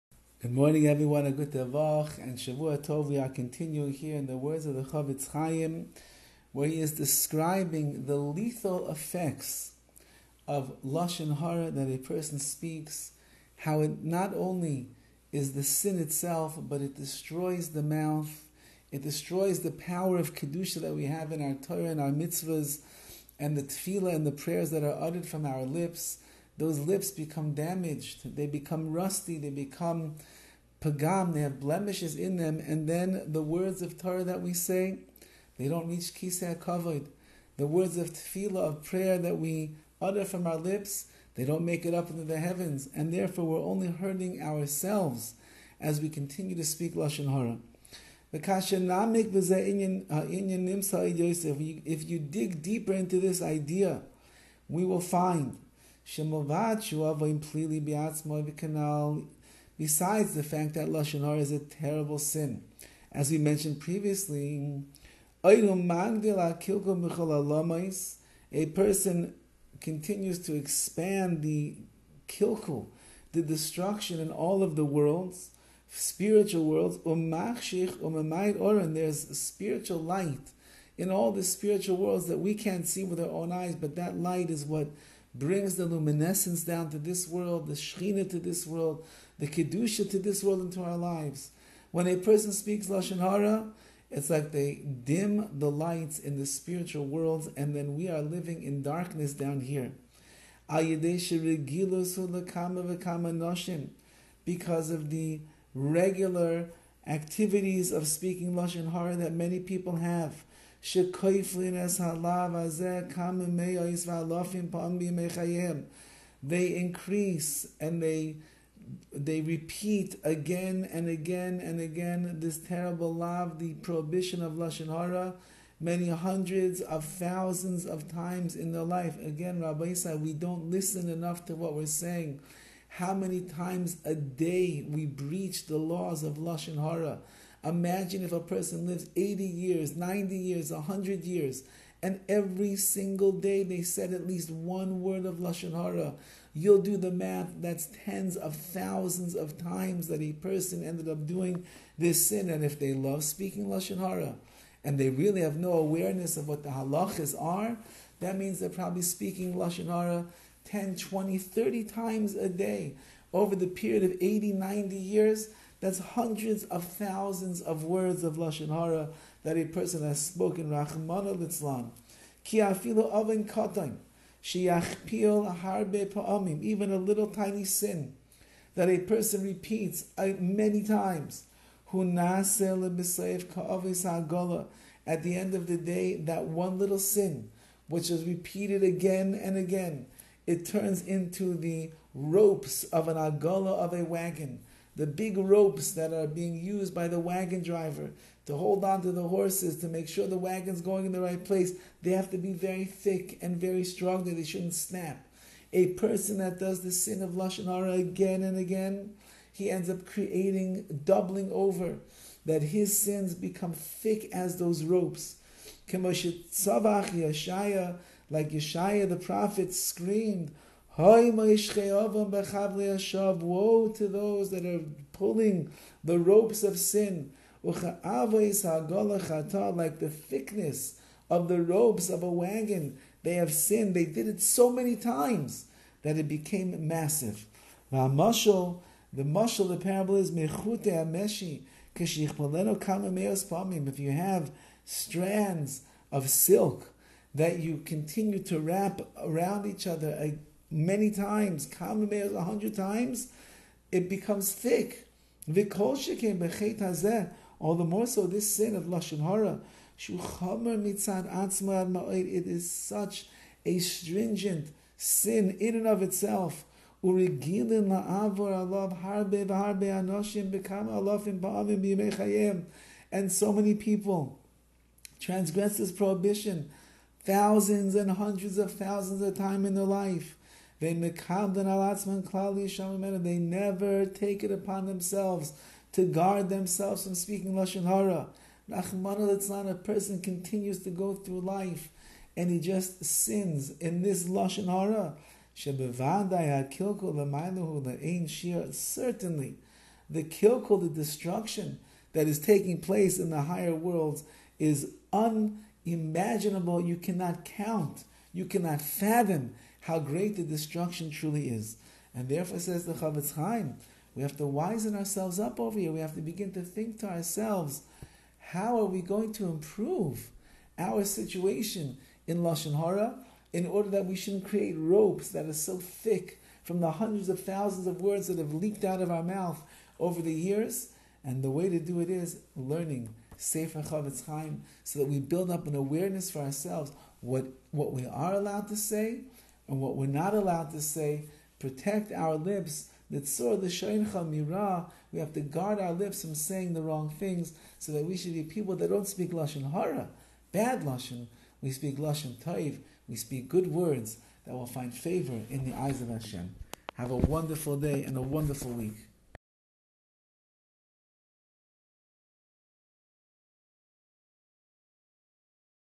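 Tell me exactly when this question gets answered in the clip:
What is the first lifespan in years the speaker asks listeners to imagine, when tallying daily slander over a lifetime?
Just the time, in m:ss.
2:19.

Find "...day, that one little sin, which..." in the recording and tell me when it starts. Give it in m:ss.
3:05.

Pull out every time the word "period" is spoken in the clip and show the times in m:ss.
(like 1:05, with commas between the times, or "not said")
2:43.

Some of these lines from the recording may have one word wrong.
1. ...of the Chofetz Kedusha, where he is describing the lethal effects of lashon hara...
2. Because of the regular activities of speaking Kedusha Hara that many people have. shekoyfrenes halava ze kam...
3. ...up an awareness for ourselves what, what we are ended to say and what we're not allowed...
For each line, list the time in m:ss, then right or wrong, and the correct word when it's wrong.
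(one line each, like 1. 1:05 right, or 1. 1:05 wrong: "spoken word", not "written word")
1. 0:04 wrong: "Chaim", not "Kedusha"
2. 1:40 wrong: "Lashon", not "Kedusha"
3. 5:35 wrong: "allowed", not "ended".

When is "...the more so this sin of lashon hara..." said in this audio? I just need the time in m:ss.
4:17.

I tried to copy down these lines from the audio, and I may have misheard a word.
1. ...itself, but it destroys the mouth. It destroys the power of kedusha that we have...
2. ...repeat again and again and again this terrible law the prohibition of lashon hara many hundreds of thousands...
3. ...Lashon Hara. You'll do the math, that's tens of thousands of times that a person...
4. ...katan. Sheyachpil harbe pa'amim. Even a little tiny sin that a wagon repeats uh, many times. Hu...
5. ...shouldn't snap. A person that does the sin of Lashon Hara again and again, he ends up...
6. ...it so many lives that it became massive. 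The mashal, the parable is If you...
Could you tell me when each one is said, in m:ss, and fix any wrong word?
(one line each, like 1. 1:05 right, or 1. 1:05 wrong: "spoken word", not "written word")
1. 0:15 right
2. 1:59 right
3. 2:25 right
4. 2:53 wrong: "person", not "wagon"
5. 3:24 right
6. 3:54 wrong: "times", not "lives".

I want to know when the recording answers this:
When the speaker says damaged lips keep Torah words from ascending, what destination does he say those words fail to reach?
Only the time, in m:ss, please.
0:36.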